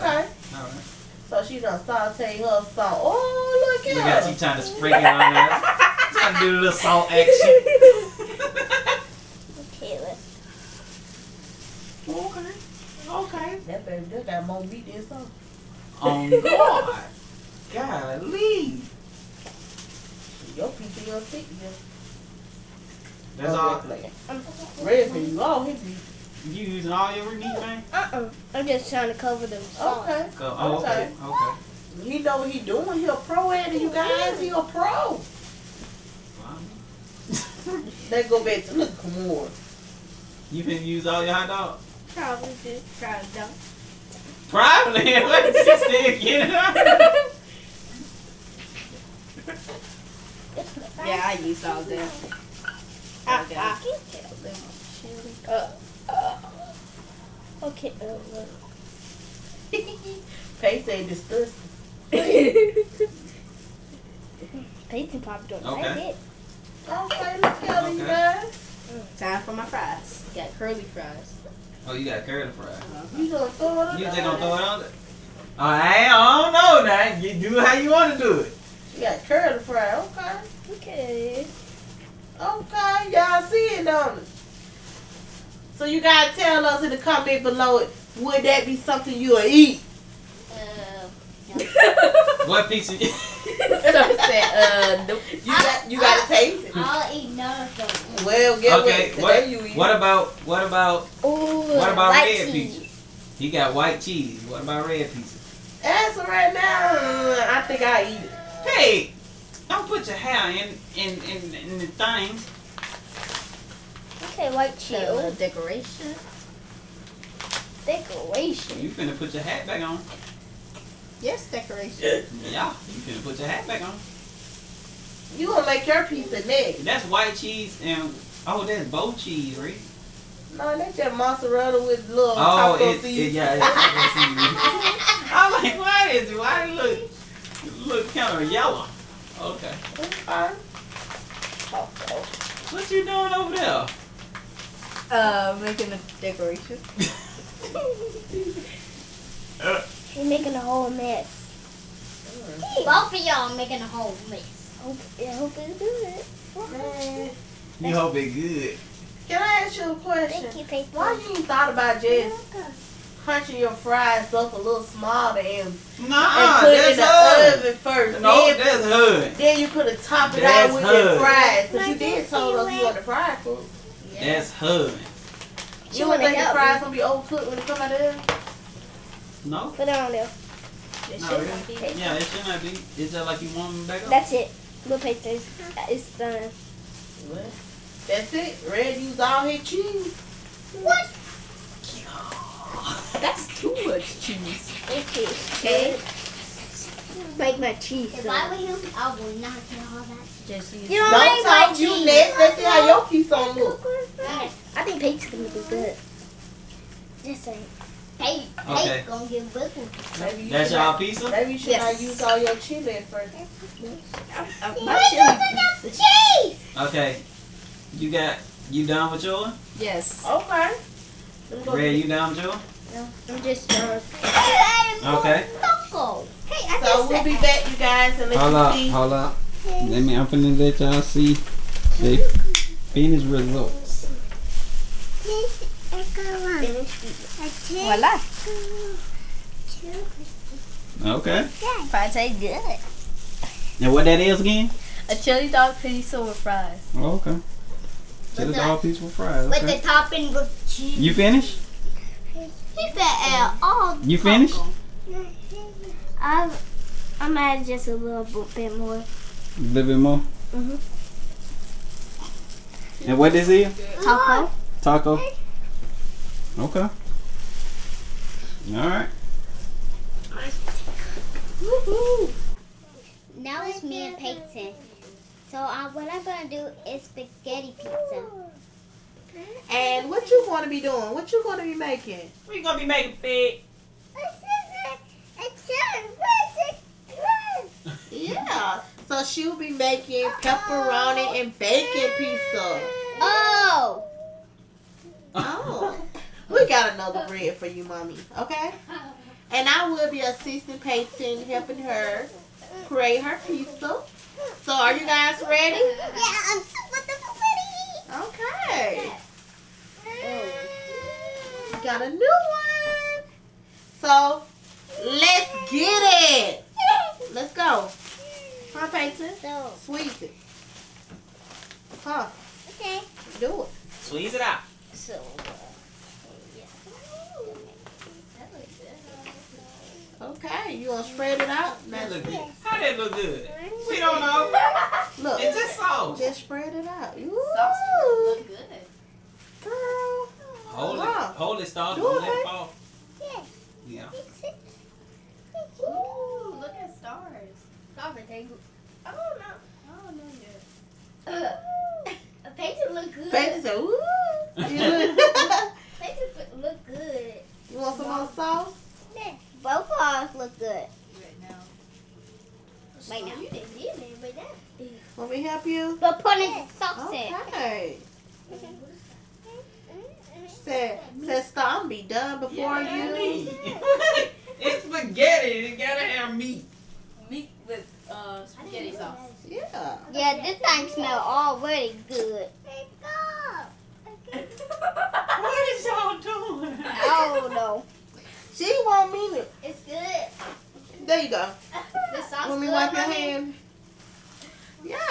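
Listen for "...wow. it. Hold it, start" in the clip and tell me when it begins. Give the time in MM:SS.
05:40.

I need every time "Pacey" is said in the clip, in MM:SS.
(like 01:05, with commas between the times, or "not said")
01:00, 01:04.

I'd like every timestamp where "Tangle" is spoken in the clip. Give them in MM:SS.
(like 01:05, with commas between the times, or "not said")
05:48.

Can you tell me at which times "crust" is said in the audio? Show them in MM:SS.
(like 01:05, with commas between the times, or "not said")
not said.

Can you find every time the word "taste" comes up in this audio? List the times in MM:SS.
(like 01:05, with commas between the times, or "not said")
01:36, 04:02.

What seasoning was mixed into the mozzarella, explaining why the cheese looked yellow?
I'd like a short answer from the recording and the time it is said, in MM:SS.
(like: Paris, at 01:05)
Taco seasoning, at 02:13.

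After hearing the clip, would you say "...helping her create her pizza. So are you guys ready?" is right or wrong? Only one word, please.
right.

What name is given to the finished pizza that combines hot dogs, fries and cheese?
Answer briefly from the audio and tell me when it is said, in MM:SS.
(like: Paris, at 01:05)
Chili dog pizza, at 04:05.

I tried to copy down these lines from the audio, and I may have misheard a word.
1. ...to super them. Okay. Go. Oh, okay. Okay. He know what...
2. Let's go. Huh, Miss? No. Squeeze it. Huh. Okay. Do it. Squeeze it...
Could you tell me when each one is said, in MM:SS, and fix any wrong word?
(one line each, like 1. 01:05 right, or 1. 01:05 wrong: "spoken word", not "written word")
1. 00:29 wrong: "cover", not "super"
2. 05:17 wrong: "Peyton", not "Miss".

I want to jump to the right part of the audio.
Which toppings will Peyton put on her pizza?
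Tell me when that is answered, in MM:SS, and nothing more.
04:50.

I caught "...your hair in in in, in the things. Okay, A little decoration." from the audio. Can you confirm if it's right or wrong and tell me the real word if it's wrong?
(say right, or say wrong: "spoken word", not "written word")
right.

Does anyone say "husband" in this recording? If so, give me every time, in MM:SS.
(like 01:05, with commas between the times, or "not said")
not said.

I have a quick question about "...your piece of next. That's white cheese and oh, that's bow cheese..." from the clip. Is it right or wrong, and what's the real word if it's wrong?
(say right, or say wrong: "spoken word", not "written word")
right.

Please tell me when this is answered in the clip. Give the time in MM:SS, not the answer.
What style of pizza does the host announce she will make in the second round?
04:37.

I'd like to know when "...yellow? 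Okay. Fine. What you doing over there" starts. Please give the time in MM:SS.
02:18.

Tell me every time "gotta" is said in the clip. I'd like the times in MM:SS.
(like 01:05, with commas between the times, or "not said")
01:26, 01:35, 06:15.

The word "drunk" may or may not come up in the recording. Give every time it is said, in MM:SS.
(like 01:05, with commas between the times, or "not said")
03:43.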